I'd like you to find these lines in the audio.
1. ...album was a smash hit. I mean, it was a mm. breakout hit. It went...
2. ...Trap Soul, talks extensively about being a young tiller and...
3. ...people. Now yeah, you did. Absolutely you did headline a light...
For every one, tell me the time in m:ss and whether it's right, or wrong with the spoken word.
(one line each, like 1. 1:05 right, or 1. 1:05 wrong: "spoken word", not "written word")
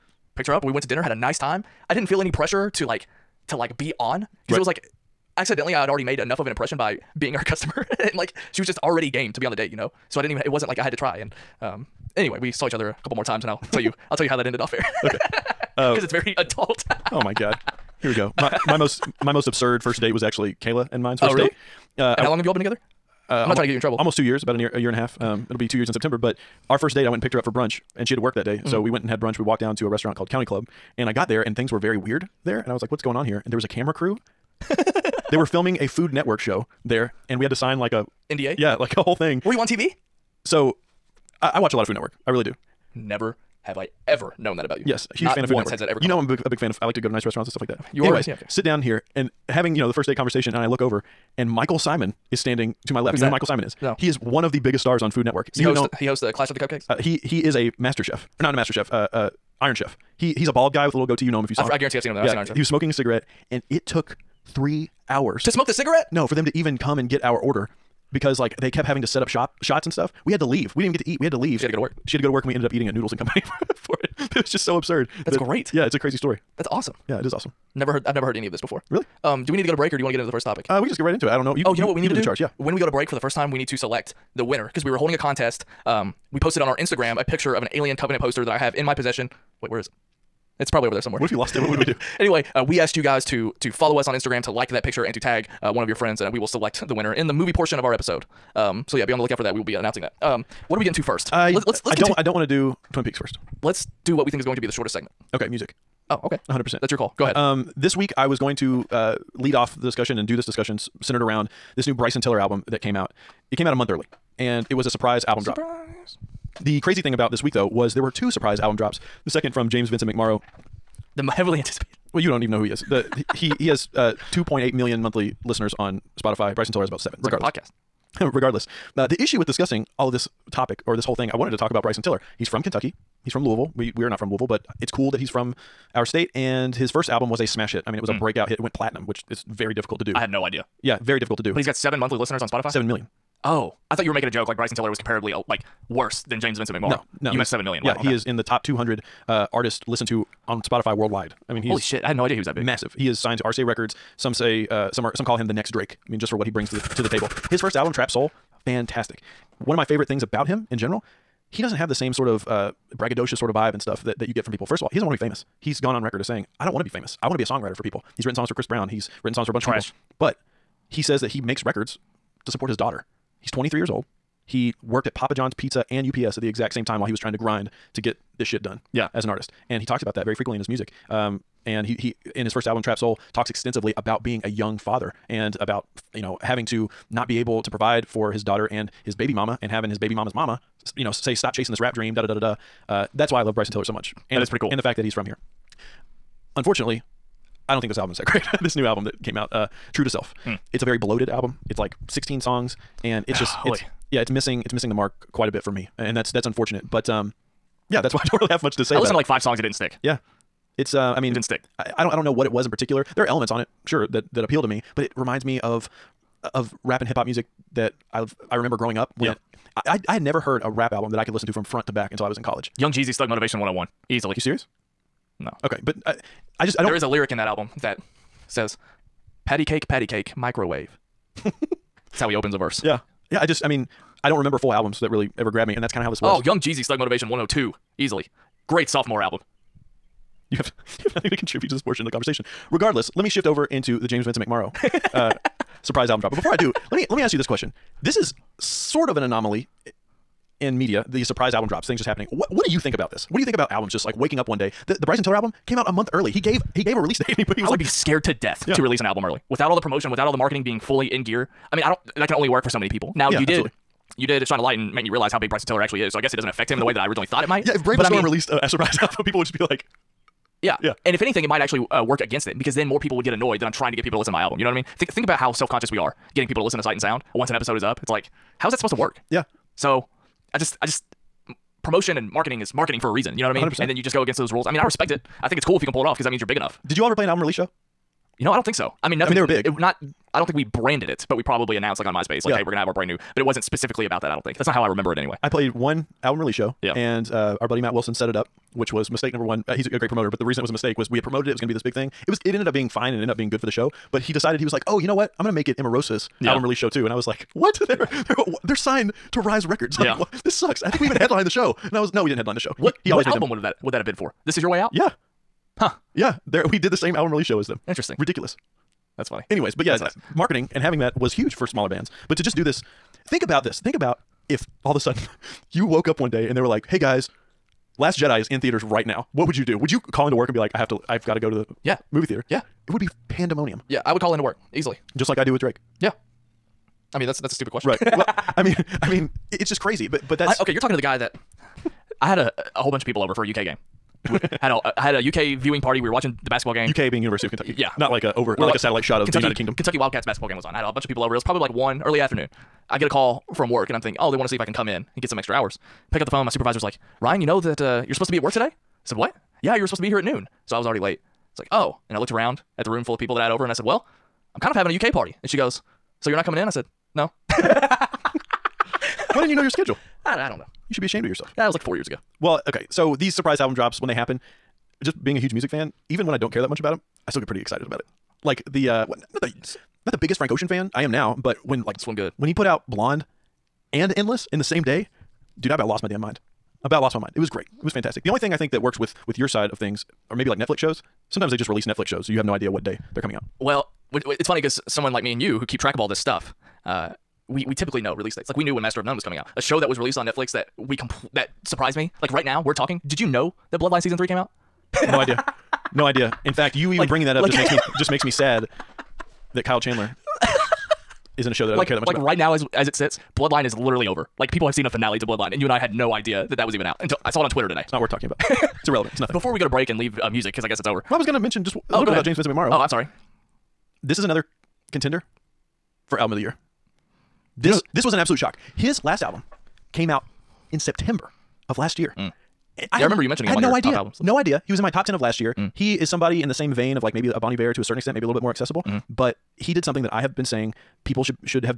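1. 2:17 right
2. 3:02 wrong: "father", not "tiller"
3. 4:22 wrong: "shine", not "headline".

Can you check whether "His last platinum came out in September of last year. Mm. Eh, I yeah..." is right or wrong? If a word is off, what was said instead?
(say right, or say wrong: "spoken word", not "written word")
wrong: "album", not "platinum".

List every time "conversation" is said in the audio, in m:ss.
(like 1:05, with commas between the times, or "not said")
0:50, 4:02.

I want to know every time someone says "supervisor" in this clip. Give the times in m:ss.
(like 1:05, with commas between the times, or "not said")
5:56.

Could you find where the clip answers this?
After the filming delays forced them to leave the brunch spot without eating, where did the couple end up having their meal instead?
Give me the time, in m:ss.
1:12.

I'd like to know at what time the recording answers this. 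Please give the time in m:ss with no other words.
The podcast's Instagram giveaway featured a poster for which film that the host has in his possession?
1:27.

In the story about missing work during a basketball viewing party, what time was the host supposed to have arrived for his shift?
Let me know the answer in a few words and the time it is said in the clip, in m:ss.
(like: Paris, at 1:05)
Noon, at 6:00.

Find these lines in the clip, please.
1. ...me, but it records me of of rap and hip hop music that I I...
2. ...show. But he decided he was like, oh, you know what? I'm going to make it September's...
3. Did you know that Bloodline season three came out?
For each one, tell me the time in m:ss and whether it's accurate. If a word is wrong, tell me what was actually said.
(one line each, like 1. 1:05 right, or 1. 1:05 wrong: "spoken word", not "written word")
1. 3:34 wrong: "reminds", not "records"
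2. 5:03 wrong: "Emarosa", not "September"
3. 6:43 right.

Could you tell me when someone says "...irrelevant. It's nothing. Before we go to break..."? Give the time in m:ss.
6:58.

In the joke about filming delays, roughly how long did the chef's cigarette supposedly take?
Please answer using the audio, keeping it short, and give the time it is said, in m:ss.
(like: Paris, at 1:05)
3 hours, at 1:04.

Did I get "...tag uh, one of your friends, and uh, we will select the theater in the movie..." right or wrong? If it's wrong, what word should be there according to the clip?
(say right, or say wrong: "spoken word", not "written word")
wrong: "winner", not "theater".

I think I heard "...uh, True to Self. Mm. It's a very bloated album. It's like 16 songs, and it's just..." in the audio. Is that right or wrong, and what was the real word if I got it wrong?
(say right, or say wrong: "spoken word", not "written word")
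right.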